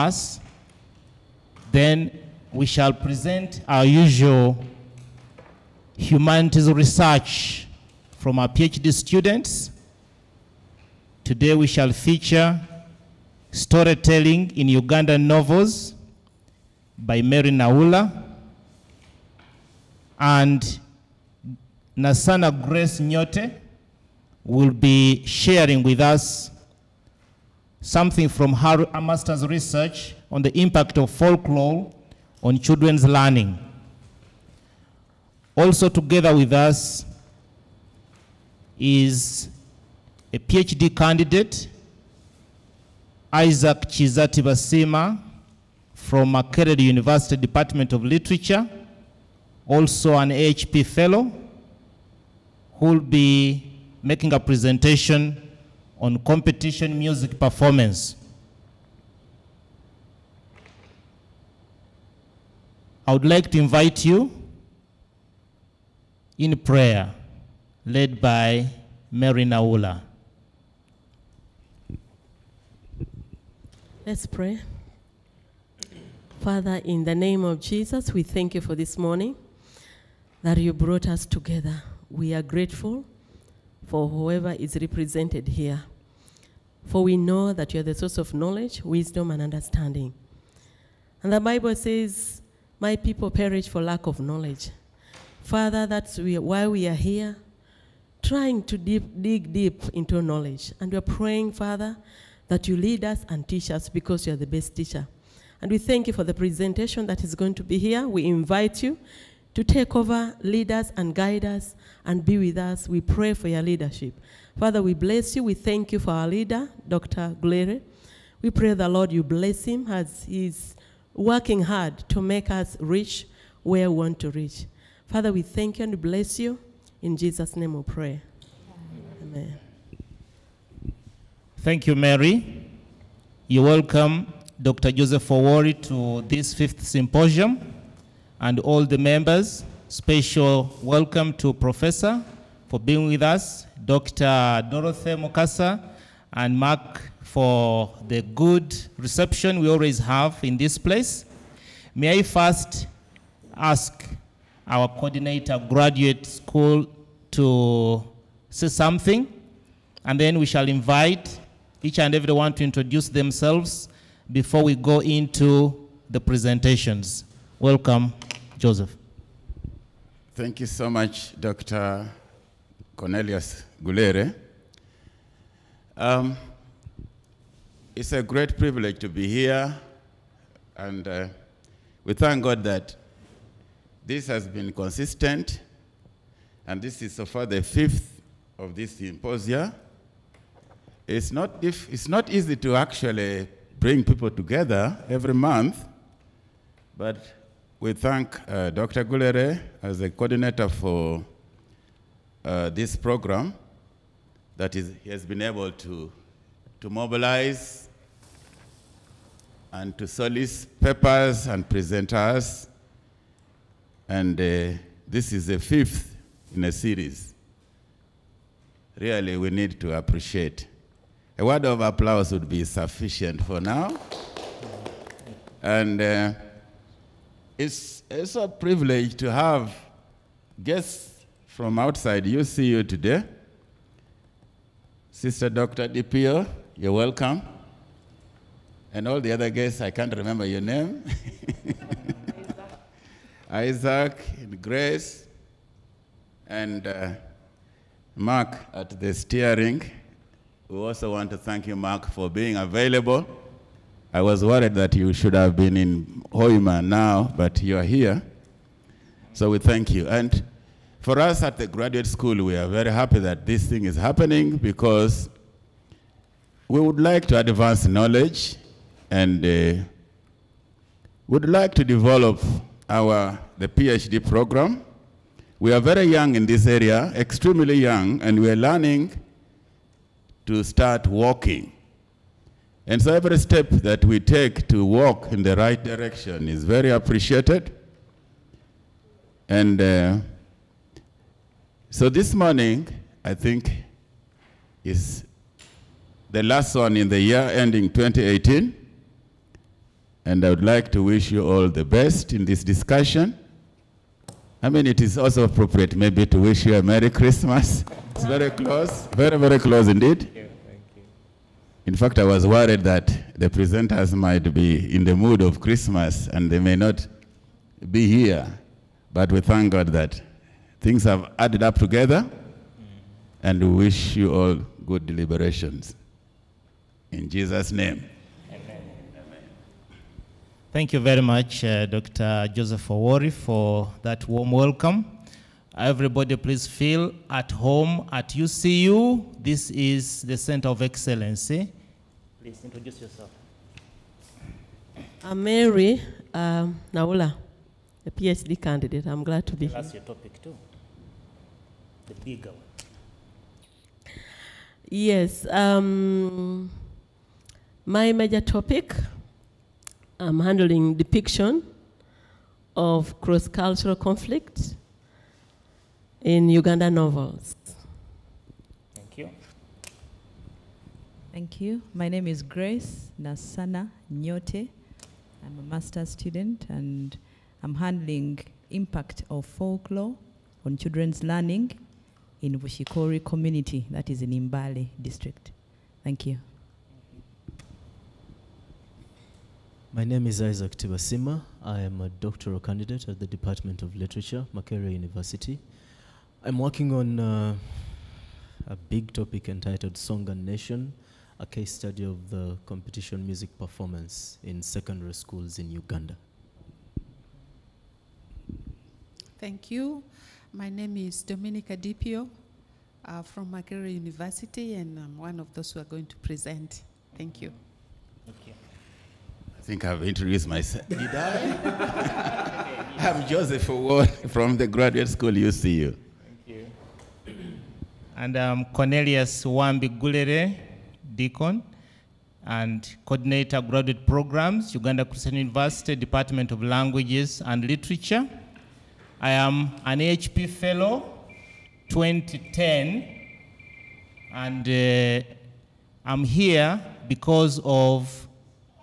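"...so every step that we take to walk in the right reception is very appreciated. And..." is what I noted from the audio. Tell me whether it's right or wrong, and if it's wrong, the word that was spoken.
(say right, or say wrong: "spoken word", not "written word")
wrong: "direction", not "reception".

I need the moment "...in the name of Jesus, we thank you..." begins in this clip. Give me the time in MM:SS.
01:16.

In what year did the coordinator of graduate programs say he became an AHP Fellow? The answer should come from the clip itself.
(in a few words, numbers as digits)
2010.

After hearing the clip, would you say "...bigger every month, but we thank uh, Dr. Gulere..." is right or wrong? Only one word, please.
wrong.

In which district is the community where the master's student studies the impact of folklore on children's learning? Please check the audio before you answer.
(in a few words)
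Mbale.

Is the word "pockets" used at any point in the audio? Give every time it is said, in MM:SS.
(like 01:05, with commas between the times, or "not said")
not said.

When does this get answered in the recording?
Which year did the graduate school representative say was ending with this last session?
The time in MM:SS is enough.
04:57.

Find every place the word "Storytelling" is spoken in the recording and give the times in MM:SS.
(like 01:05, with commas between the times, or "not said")
00:13.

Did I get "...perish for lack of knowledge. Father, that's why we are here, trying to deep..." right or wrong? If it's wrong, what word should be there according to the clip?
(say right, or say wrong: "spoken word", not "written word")
right.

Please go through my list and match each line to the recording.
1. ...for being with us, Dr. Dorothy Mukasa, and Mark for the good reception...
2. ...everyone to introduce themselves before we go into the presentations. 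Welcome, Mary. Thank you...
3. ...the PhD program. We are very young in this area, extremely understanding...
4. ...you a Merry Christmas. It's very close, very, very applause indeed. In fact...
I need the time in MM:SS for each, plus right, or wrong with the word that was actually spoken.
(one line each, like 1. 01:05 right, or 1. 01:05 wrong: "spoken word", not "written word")
1. 02:22 right
2. 02:42 wrong: "Joseph", not "Mary"
3. 04:33 wrong: "young", not "understanding"
4. 05:06 wrong: "close", not "applause".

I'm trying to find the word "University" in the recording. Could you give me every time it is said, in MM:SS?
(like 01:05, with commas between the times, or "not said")
00:46, 06:34, 06:53, 07:15.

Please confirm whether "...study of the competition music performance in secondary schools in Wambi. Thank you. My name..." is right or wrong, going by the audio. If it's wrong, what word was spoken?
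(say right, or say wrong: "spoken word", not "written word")
wrong: "Uganda", not "Wambi".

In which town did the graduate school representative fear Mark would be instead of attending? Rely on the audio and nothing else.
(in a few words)
Hoima.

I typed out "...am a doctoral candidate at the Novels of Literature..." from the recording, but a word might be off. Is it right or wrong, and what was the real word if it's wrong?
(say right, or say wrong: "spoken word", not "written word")
wrong: "Department", not "Novels".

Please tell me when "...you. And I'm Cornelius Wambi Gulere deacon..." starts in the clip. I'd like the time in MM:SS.
07:06.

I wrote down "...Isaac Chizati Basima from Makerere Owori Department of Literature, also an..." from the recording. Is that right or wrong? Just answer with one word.
wrong.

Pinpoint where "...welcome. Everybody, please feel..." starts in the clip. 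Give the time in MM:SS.
05:34.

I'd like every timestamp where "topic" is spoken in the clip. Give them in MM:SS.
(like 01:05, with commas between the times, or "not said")
05:50, 05:58, 06:39.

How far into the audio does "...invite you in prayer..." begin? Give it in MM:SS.
01:03.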